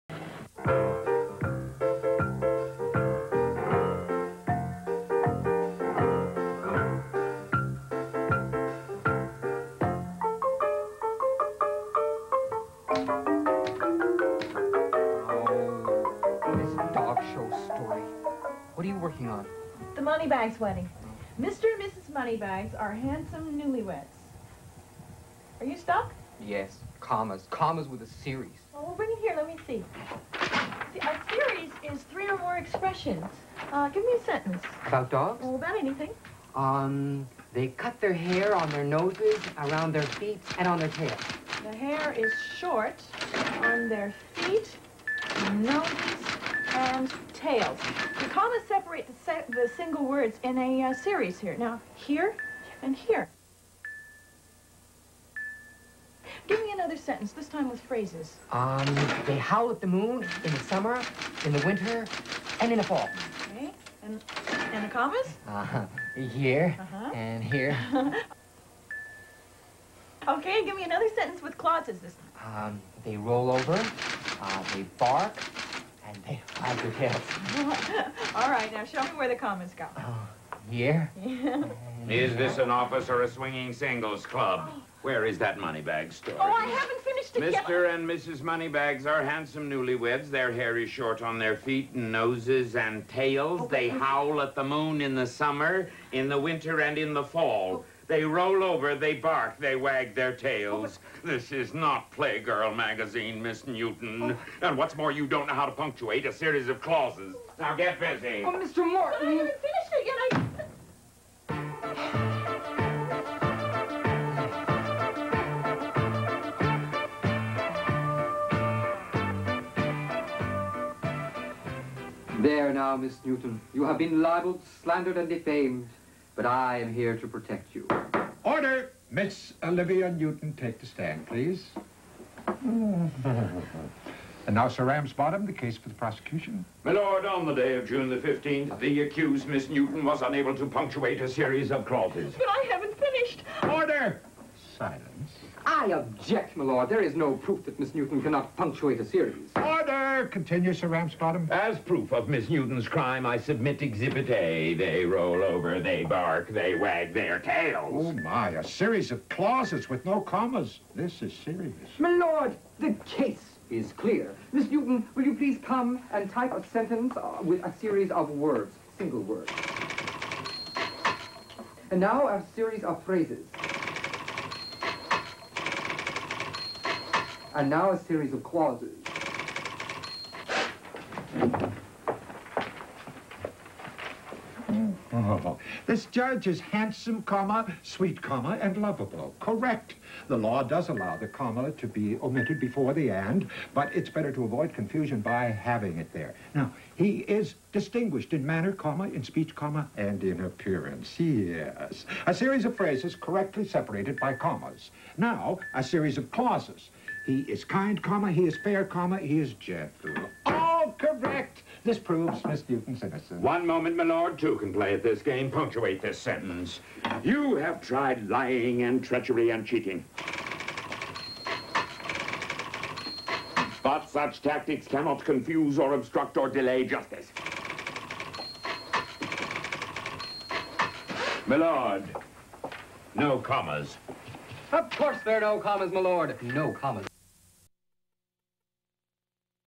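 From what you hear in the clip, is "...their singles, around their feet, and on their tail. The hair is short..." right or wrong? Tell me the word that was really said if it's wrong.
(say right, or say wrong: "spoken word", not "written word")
wrong: "noses", not "singles".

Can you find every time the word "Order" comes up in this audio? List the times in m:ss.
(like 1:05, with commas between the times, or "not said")
2:08, 2:23, 2:29.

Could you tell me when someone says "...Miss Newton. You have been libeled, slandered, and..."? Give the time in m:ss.
2:02.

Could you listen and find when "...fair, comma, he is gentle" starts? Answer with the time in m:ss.
3:28.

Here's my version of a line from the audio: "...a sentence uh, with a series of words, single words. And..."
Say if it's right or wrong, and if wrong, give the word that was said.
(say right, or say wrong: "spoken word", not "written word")
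right.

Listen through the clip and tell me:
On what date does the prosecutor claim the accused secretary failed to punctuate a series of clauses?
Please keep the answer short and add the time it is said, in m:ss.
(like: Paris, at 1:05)
June 15th, at 2:17.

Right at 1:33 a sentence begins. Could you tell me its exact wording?
Oh, they howl at the moon in the summer, in the winter, and in the fall.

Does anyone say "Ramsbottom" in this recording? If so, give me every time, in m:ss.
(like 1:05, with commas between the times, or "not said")
2:14, 2:30.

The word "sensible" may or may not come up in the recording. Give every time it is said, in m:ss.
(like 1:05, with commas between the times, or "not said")
not said.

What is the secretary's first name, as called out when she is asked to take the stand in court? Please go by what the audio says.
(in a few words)
Olivia.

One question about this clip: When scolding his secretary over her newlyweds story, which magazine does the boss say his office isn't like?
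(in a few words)
Playgirl.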